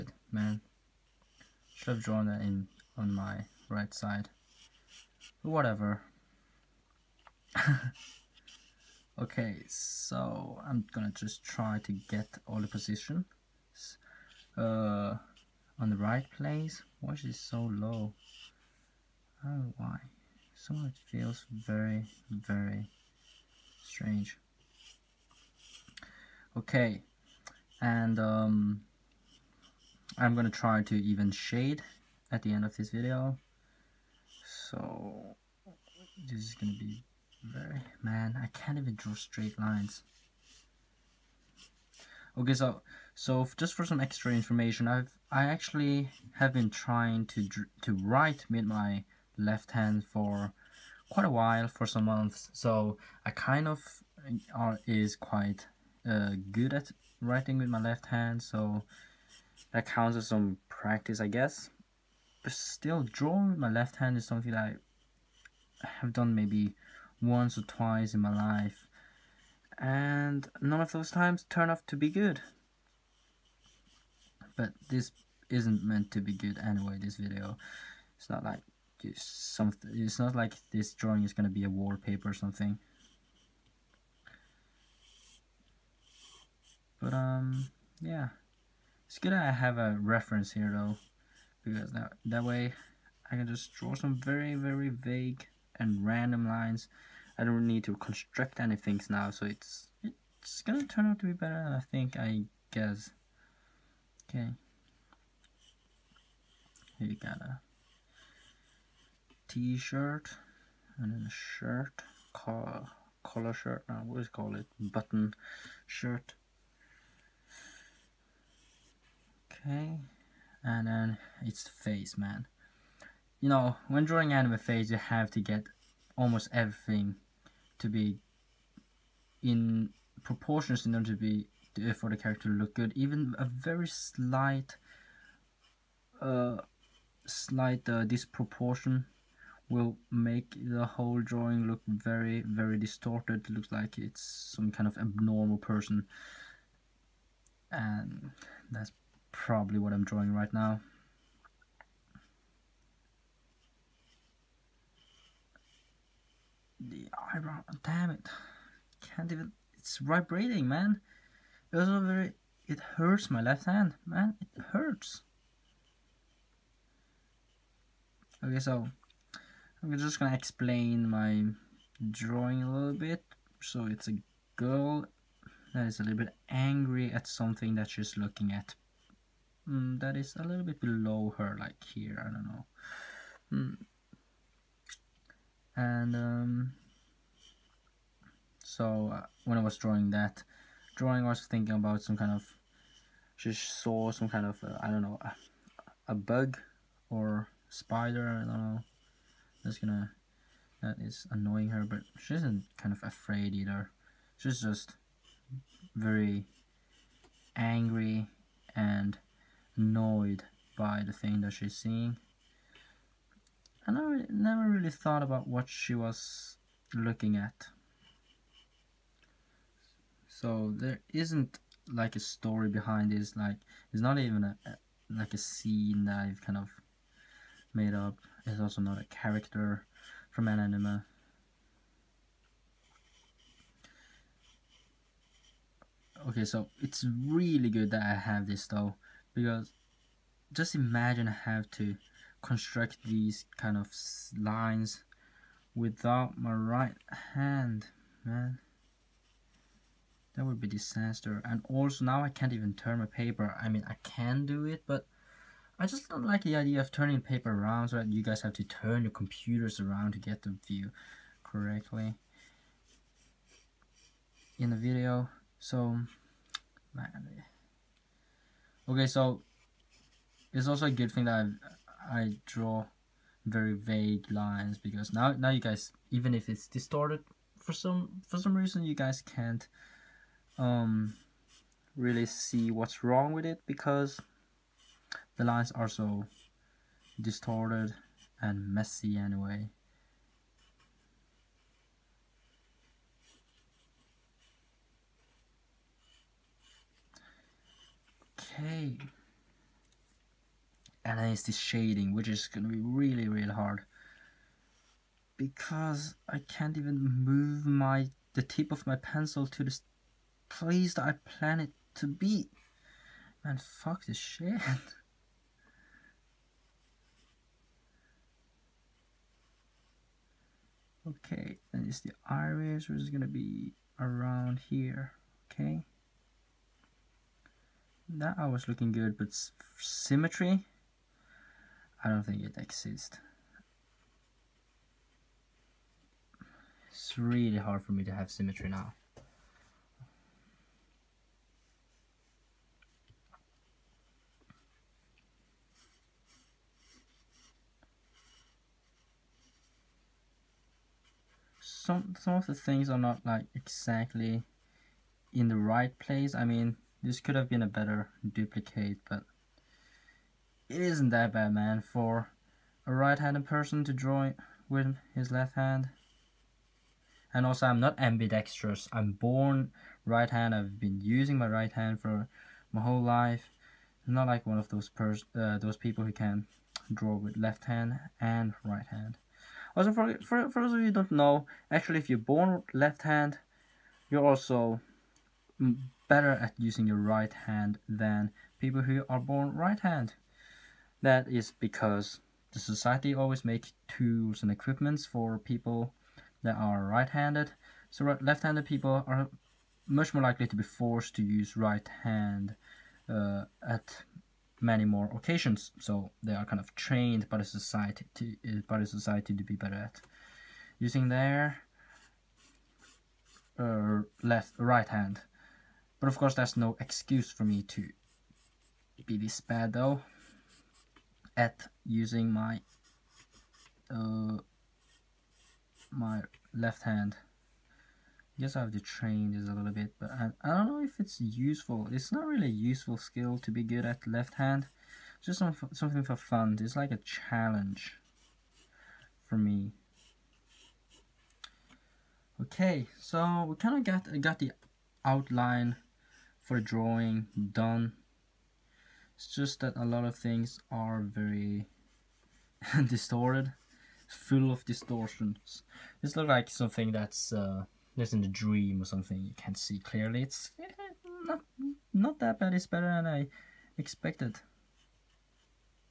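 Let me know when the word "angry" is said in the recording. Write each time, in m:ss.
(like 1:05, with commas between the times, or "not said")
2:56, 3:27.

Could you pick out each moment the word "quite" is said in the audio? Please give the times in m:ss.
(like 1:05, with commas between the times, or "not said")
0:51, 0:55.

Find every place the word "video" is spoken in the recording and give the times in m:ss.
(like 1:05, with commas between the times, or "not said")
0:32, 1:17, 4:24.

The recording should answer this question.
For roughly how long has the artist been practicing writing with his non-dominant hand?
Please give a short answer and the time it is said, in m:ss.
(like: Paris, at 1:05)
some months, at 0:51.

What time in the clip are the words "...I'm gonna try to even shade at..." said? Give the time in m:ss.
0:30.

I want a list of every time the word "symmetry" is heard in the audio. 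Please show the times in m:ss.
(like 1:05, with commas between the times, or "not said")
5:29, 5:38.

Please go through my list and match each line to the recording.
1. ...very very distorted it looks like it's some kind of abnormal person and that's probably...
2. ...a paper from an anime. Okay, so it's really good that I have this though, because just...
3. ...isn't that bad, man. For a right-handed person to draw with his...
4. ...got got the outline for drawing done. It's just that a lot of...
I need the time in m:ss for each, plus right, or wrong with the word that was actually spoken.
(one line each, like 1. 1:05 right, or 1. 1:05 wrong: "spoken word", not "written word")
1. 2:21 right
2. 3:48 wrong: "character", not "paper"
3. 6:00 right
4. 7:23 right.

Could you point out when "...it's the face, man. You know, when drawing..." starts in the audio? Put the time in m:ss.
2:01.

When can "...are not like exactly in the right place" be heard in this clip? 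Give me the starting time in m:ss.
5:52.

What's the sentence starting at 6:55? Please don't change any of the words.
But of course, there's no excuse for me to be this bad though at using my uh, my left hand.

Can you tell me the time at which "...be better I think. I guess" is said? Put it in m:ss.
1:41.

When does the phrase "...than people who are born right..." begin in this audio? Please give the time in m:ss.
6:27.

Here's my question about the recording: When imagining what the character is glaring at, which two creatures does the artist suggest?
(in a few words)
a bug or spider.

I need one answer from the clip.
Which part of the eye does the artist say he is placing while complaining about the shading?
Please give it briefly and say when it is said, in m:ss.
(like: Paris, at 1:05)
the iris, at 5:21.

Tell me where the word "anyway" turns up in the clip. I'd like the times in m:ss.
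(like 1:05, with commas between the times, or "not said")
1:16, 4:49.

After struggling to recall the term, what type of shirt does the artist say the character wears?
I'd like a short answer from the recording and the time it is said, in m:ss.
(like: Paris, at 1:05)
button shirt, at 1:54.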